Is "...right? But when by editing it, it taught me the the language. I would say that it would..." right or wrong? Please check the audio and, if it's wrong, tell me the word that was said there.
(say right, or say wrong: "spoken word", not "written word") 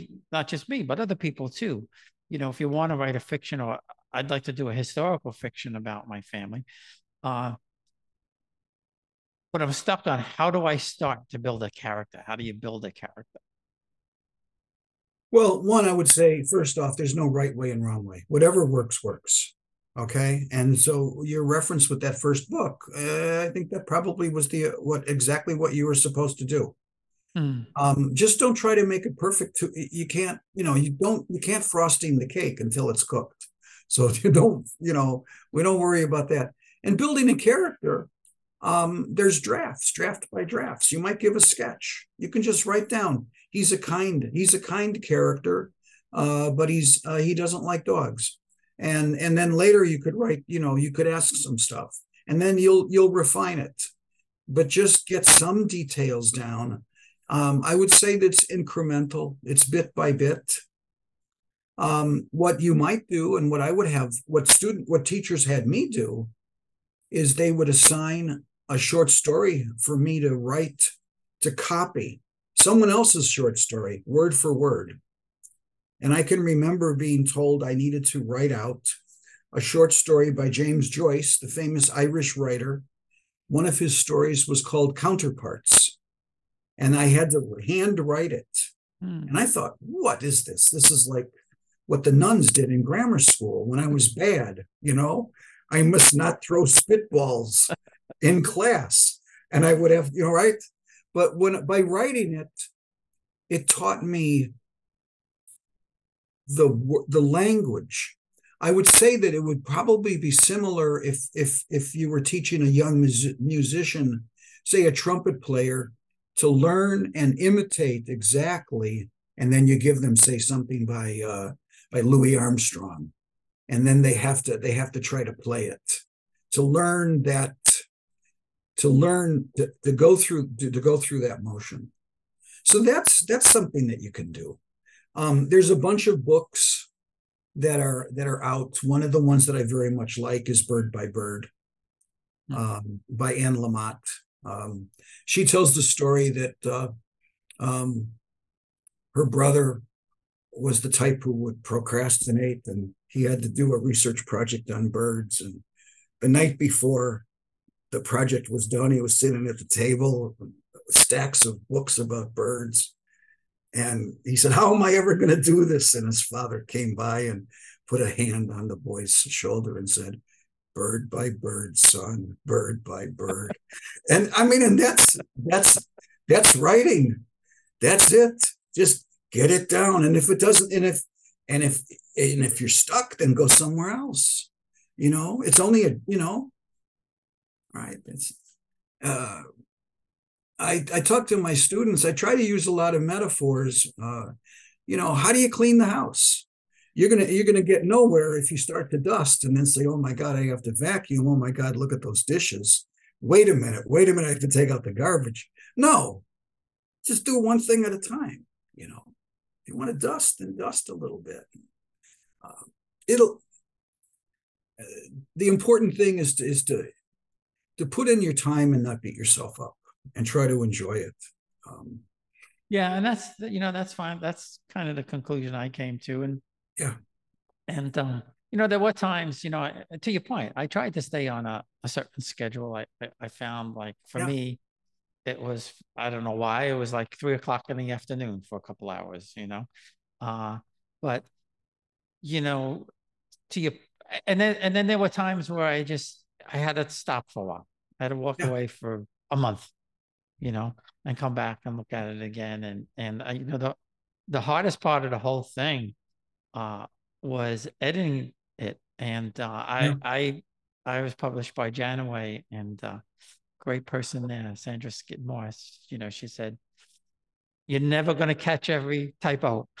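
wrong: "writing", not "editing".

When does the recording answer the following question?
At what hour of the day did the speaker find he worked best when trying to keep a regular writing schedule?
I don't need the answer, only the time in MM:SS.
03:57.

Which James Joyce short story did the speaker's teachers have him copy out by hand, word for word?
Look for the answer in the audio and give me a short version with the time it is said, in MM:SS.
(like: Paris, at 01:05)
Counterparts, at 01:24.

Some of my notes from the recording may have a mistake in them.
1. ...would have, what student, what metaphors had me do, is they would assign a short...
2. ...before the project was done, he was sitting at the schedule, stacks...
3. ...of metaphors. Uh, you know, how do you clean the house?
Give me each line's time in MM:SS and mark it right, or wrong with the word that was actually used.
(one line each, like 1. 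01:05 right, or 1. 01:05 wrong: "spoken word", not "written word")
1. 01:03 wrong: "teachers", not "metaphors"
2. 02:36 wrong: "table", not "schedule"
3. 03:12 right.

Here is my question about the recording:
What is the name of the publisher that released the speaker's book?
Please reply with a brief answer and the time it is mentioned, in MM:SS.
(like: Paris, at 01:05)
Janaway, at 04:21.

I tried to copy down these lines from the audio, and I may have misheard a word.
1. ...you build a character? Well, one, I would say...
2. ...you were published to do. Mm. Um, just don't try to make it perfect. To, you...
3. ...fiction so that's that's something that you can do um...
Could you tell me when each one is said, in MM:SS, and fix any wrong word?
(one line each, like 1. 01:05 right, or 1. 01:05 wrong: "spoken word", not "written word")
1. 00:12 right
2. 00:25 wrong: "supposed", not "published"
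3. 02:11 wrong: "motion", not "fiction".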